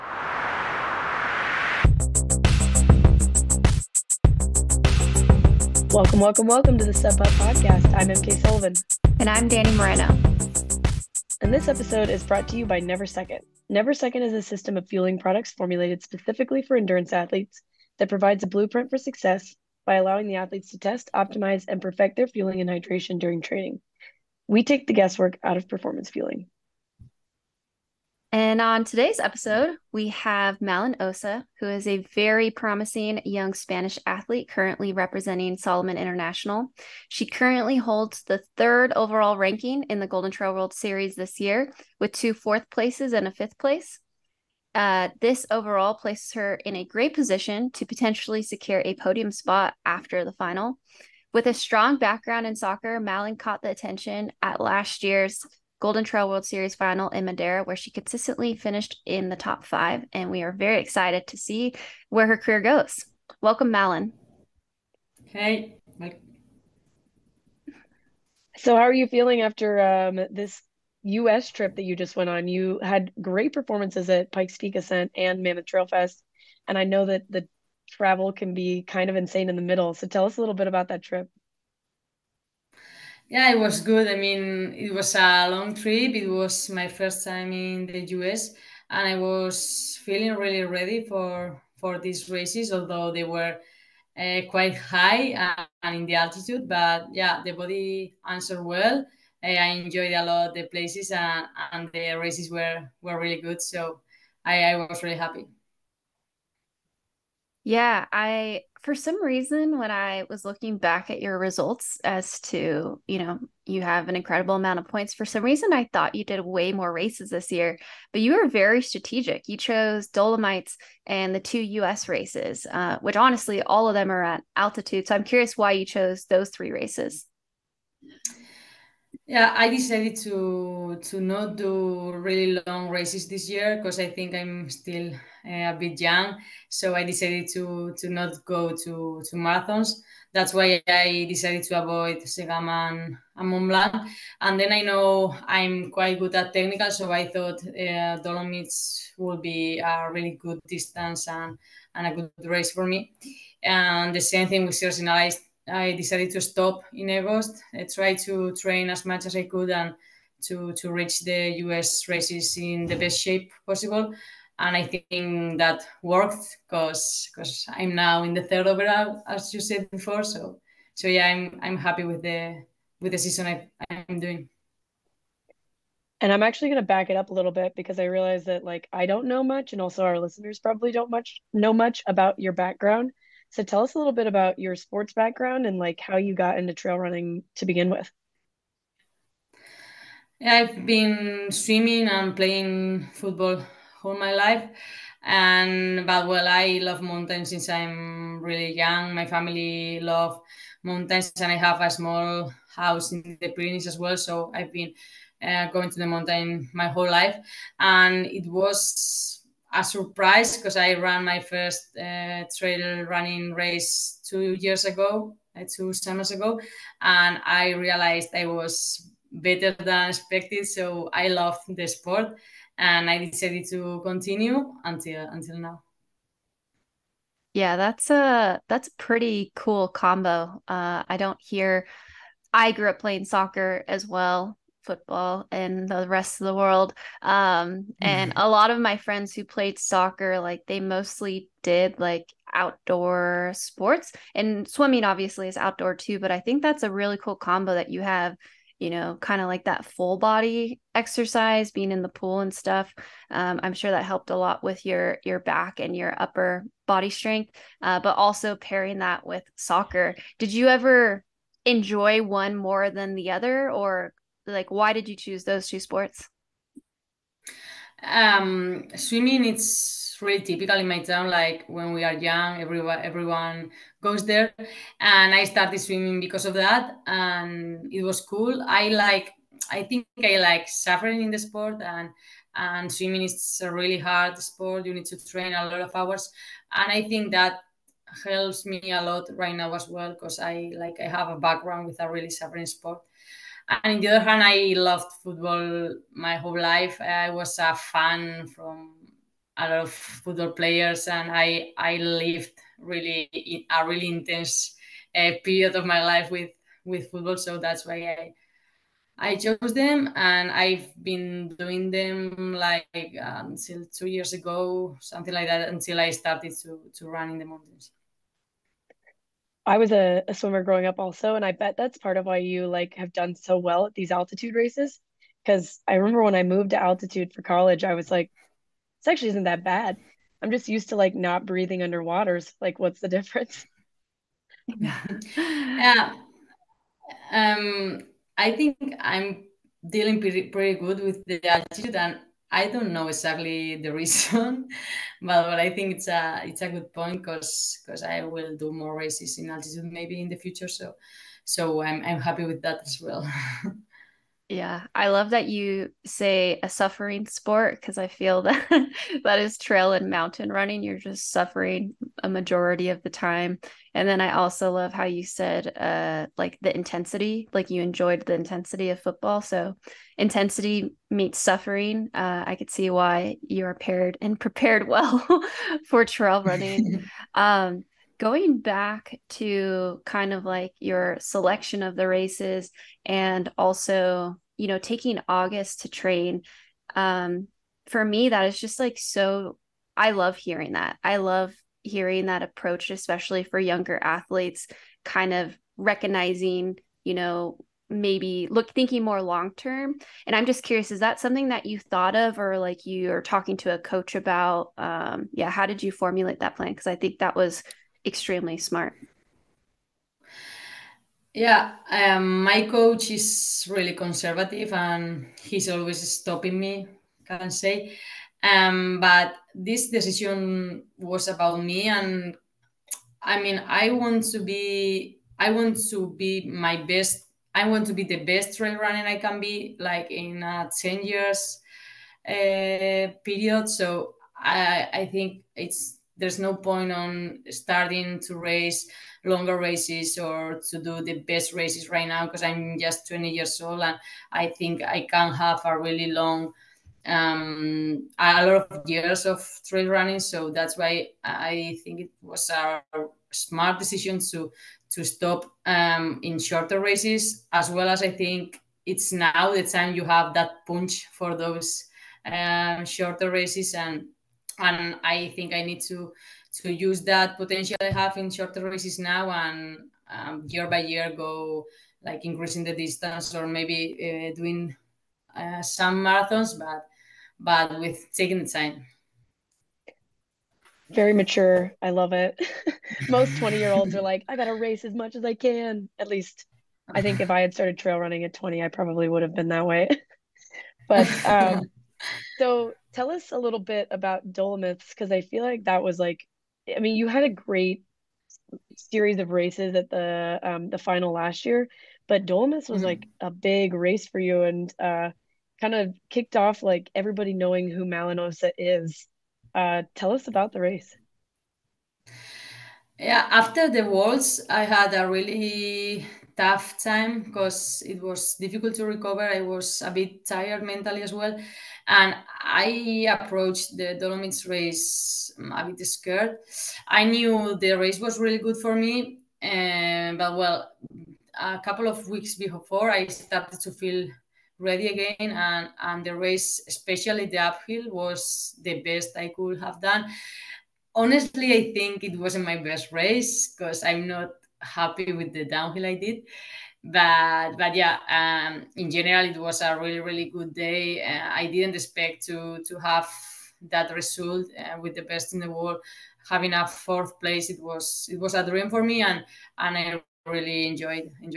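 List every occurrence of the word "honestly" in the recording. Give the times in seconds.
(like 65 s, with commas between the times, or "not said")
123 s, 540 s.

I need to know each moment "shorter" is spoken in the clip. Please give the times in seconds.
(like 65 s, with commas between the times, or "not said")
456 s, 462 s, 468 s.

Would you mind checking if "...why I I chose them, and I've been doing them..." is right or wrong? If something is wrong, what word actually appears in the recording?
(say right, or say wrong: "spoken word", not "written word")
right.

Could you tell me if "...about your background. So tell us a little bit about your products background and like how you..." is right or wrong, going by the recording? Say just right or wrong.
wrong.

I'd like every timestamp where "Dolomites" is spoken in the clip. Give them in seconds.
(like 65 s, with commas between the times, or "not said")
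120 s, 148 s, 494 s, 502 s, 523 s.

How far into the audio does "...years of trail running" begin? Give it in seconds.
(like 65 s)
448 s.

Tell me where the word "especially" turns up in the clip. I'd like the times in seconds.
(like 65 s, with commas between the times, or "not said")
392 s, 536 s.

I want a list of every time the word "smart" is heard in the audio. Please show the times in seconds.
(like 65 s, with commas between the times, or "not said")
408 s, 453 s.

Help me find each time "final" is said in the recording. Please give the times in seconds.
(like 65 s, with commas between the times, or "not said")
50 s, 56 s, 500 s.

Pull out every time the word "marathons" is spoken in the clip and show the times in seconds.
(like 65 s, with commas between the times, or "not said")
139 s, 476 s.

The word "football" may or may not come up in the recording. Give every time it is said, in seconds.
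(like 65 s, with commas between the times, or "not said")
193 s, 234 s, 295 s, 299 s, 307 s, 369 s.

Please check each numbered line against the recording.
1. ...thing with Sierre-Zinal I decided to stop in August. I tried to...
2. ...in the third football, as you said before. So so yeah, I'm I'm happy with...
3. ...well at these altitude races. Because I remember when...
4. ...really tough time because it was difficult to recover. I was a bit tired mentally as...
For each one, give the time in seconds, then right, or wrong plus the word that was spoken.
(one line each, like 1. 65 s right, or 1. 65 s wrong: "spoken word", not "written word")
1. 154 s right
2. 168 s wrong: "overall", not "football"
3. 323 s right
4. 515 s right.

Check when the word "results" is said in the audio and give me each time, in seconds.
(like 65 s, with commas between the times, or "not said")
111 s, 553 s.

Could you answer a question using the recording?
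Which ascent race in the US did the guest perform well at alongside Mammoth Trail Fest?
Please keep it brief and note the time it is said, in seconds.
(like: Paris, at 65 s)
Pikes Peak Ascent, at 74 s.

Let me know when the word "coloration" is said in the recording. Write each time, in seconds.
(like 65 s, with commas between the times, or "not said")
not said.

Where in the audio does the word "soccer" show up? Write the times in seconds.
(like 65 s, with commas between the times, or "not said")
52 s, 233 s, 239 s, 259 s.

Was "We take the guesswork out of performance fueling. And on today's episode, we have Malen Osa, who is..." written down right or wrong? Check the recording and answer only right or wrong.
right.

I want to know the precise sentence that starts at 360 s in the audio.
You're just suffering a majority of the time.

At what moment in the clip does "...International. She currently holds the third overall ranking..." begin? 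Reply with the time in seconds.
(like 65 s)
35 s.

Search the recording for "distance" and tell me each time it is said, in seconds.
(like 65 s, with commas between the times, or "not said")
150 s, 472 s.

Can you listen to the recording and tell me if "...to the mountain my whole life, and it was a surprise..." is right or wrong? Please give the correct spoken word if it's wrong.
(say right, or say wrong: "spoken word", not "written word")
right.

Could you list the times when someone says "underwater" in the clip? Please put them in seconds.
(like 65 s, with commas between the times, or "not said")
331 s.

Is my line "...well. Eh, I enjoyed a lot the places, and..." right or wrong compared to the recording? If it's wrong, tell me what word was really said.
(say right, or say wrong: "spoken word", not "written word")
right.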